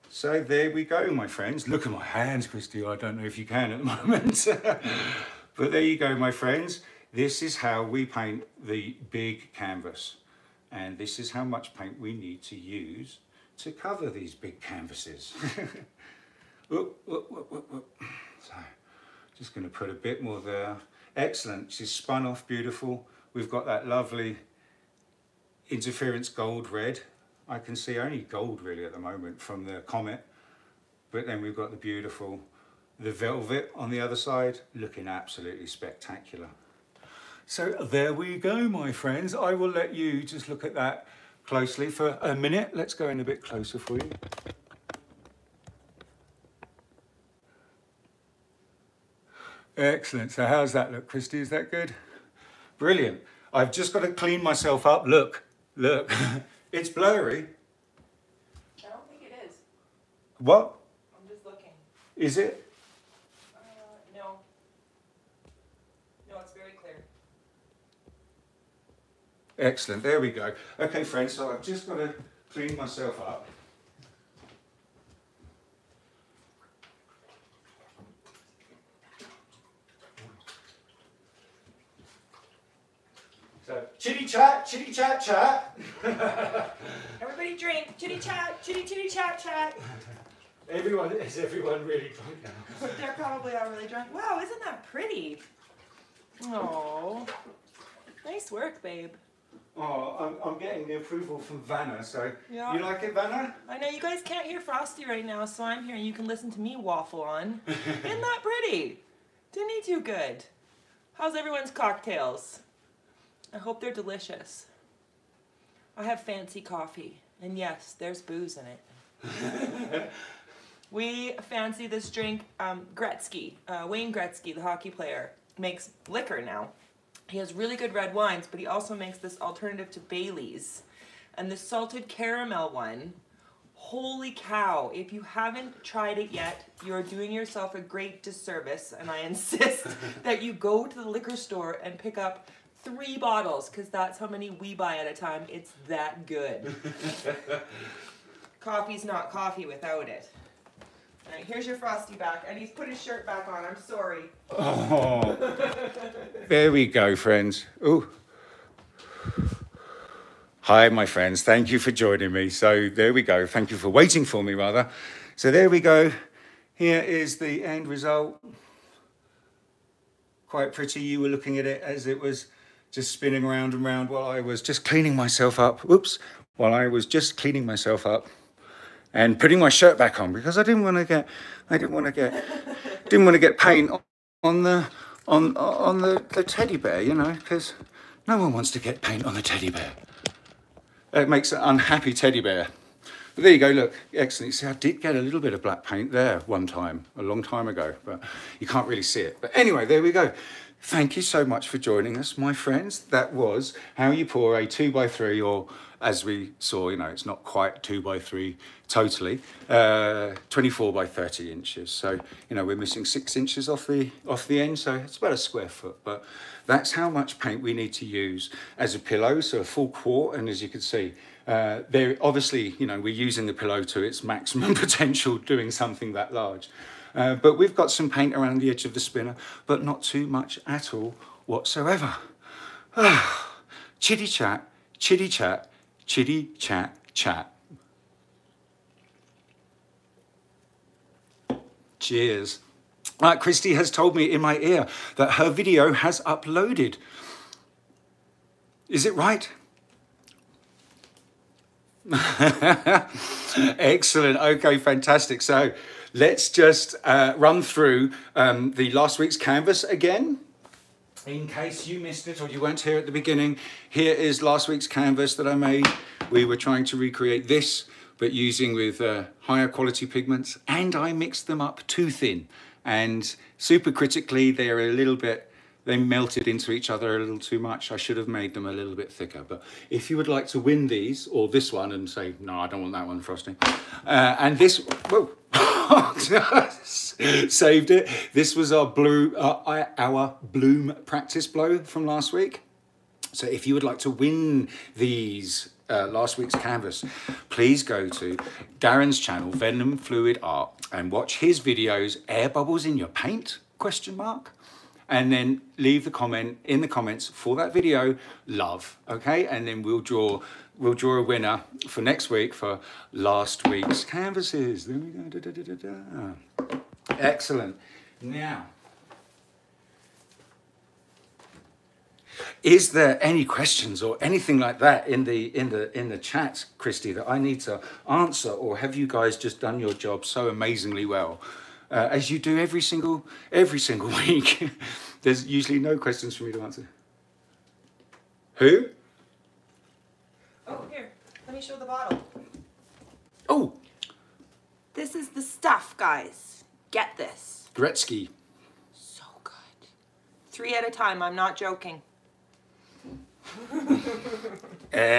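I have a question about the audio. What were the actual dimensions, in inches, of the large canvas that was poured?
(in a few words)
24 by 30 inches.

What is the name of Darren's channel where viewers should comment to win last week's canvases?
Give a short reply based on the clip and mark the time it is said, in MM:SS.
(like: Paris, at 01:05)
Venom Fluid Art, at 04:59.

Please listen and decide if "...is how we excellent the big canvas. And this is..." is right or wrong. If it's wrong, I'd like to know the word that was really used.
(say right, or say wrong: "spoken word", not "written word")
wrong: "paint", not "excellent".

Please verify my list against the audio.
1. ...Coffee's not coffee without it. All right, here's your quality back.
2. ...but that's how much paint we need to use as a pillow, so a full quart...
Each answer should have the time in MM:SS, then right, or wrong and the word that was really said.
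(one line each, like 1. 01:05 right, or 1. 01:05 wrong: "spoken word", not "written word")
1. 02:28 wrong: "frosty", not "quality"
2. 03:36 right.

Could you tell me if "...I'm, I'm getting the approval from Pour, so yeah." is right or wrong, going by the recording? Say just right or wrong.
wrong.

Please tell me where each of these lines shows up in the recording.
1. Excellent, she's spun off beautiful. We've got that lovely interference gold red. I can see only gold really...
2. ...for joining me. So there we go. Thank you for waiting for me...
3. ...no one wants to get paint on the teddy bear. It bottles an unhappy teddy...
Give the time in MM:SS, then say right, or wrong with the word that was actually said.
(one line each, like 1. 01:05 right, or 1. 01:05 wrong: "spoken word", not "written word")
1. 00:21 right
2. 02:41 right
3. 03:08 wrong: "makes", not "bottles".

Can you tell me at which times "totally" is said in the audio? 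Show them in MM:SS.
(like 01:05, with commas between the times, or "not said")
03:28.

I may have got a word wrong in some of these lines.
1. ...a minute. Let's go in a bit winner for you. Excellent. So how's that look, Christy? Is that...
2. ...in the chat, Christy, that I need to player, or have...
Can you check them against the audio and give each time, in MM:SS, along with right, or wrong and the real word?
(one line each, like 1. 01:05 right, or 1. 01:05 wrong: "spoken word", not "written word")
1. 00:42 wrong: "closer", not "winner"
2. 05:25 wrong: "answer", not "player".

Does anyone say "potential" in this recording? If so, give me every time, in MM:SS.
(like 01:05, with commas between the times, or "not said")
03:44.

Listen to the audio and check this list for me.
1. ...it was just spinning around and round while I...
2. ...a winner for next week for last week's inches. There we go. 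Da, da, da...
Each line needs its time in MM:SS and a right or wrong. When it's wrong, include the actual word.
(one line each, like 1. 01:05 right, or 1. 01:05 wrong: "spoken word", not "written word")
1. 02:52 right
2. 05:11 wrong: "canvases", not "inches".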